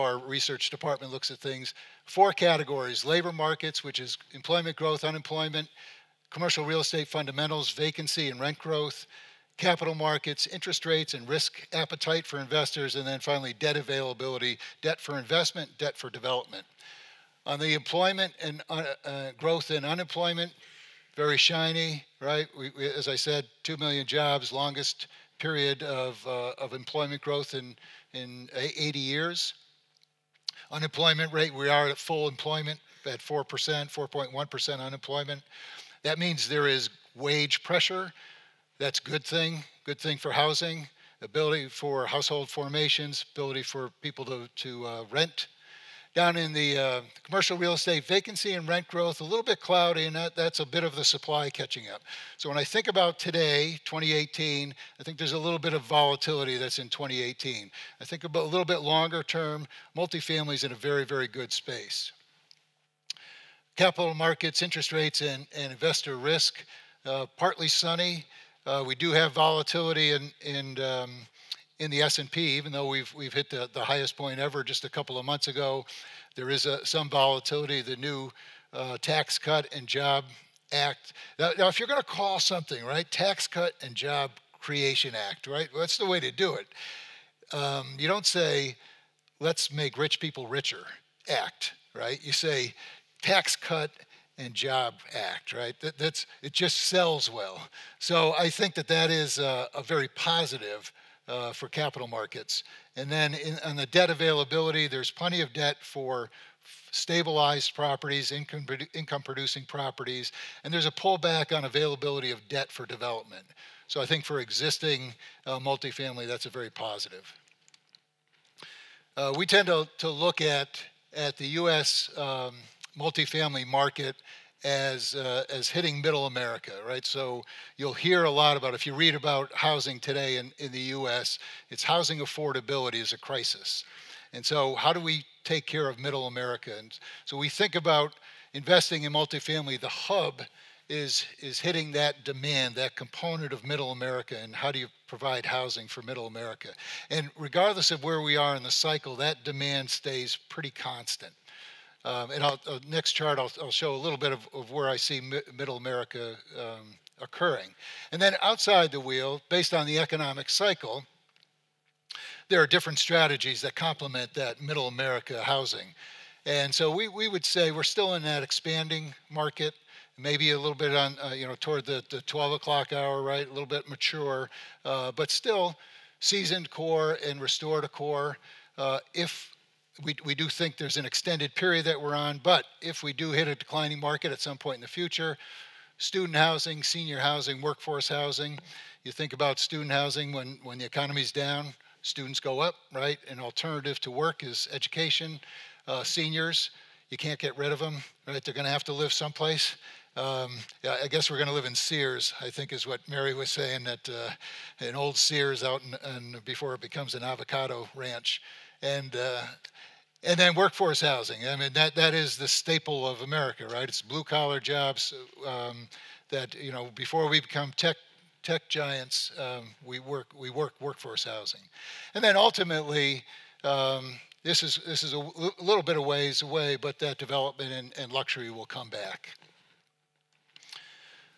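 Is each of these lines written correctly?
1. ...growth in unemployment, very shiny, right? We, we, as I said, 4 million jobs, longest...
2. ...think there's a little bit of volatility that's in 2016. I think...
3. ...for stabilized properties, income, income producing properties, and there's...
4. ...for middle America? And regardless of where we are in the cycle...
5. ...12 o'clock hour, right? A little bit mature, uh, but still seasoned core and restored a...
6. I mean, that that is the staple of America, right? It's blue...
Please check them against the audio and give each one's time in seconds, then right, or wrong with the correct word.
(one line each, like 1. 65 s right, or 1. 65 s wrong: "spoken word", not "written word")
1. 19 s wrong: "2", not "4"
2. 55 s wrong: "2018", not "2016"
3. 105 s right
4. 145 s right
5. 172 s right
6. 211 s right.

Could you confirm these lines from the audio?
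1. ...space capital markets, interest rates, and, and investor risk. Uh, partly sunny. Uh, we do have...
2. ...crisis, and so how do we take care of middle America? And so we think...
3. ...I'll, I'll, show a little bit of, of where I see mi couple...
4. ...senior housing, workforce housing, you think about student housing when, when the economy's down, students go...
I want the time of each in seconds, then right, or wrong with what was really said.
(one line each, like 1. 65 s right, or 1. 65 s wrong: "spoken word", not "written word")
1. 61 s right
2. 133 s right
3. 153 s wrong: "middle", not "couple"
4. 186 s right.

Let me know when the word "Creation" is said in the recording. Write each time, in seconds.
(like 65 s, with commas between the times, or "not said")
84 s.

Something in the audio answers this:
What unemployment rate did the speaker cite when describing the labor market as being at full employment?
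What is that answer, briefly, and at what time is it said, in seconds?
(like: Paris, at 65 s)
4.1%, at 33 s.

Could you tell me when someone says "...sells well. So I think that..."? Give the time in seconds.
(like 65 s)
96 s.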